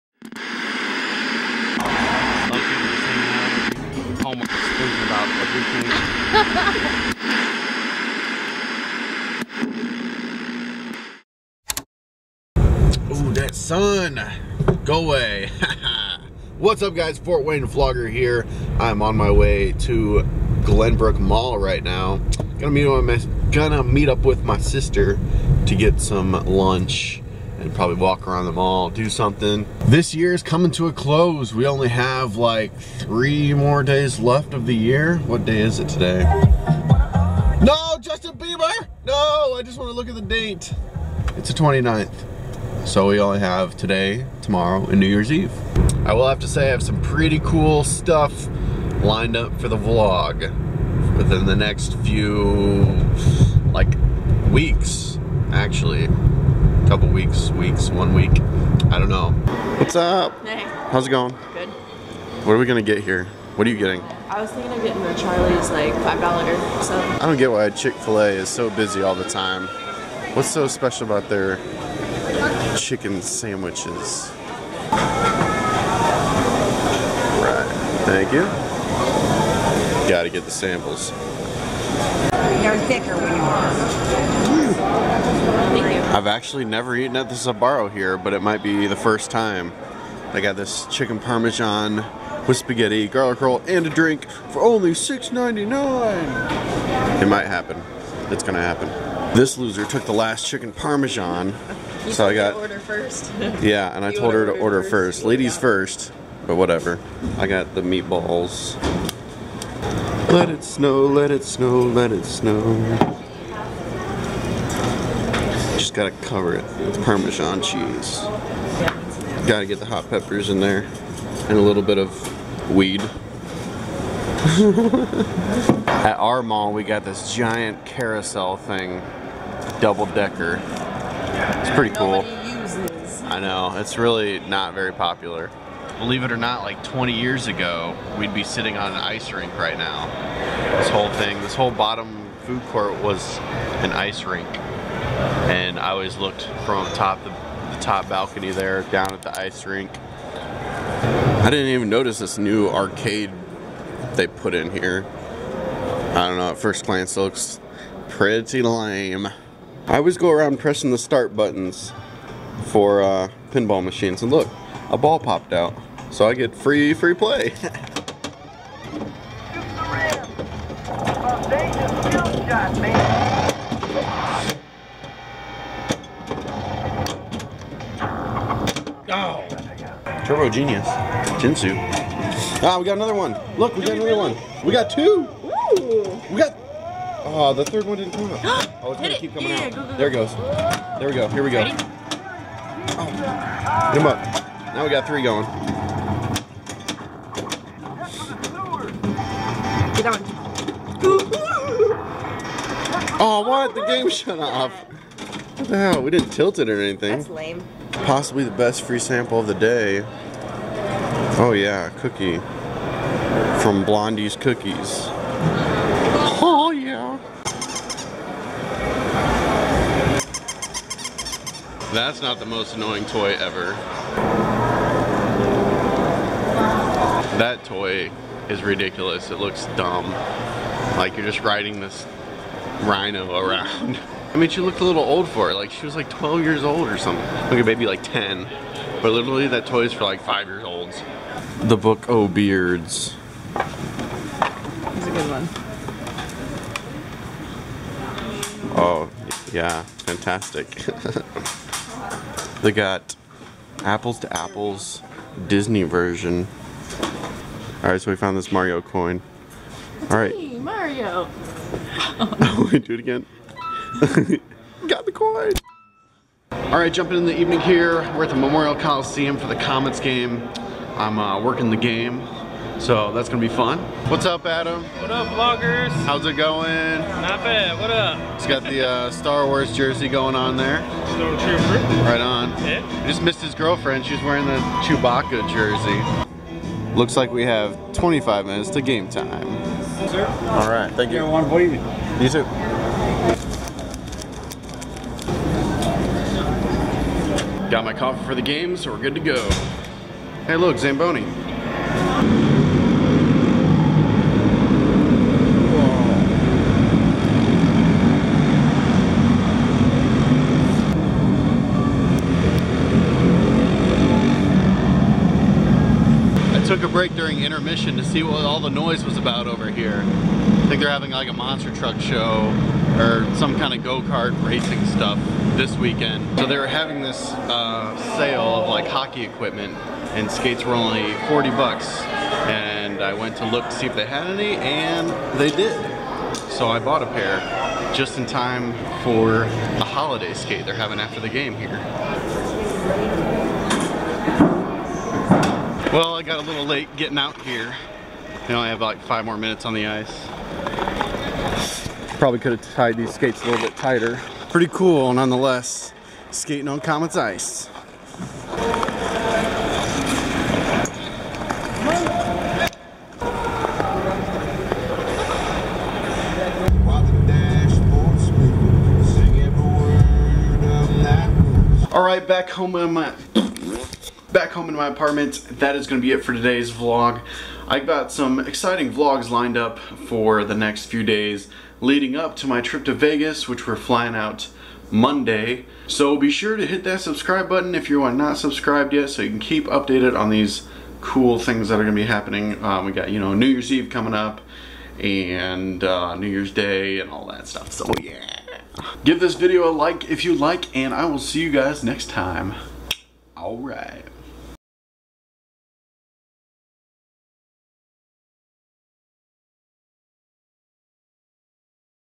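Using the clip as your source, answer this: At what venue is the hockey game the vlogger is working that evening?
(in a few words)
Memorial Coliseum.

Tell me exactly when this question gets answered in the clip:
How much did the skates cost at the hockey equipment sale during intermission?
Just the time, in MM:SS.
05:31.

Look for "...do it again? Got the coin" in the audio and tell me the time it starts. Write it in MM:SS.
04:22.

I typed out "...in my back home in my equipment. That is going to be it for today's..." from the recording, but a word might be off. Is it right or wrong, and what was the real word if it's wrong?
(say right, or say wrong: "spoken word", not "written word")
wrong: "apartment", not "equipment".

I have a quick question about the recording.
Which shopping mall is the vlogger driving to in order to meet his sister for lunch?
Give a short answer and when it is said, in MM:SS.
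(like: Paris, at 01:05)
Glenbrook Mall, at 00:20.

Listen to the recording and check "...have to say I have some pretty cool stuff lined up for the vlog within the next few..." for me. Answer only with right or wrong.
right.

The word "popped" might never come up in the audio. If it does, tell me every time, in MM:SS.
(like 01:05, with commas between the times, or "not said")
02:45.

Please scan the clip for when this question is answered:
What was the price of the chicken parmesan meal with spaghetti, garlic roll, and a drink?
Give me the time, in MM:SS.
01:34.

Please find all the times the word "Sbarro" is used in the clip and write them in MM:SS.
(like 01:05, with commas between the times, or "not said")
01:27.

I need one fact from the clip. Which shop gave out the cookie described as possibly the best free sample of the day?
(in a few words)
Blondie's Cookies.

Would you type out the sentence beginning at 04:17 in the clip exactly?
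Alright, so we found this Mario coin.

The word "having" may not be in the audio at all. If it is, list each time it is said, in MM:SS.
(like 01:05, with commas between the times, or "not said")
05:20, 05:26, 05:40.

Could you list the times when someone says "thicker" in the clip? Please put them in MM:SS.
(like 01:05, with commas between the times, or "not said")
01:22.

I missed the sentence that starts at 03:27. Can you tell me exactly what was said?
That's lame possibly the best free sample of the day.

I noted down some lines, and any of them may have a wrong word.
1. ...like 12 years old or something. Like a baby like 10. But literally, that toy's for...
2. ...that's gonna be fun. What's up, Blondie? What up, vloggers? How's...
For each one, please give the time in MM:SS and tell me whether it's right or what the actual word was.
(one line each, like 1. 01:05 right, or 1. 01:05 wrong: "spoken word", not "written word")
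1. 03:55 right
2. 04:33 wrong: "Adam", not "Blondie".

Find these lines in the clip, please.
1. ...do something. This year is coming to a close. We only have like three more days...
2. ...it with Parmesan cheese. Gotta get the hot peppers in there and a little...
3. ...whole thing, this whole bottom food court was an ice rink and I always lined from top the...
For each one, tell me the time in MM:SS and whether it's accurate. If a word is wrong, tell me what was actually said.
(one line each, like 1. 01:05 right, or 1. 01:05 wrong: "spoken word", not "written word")
1. 00:28 right
2. 01:56 right
3. 02:20 wrong: "looked", not "lined".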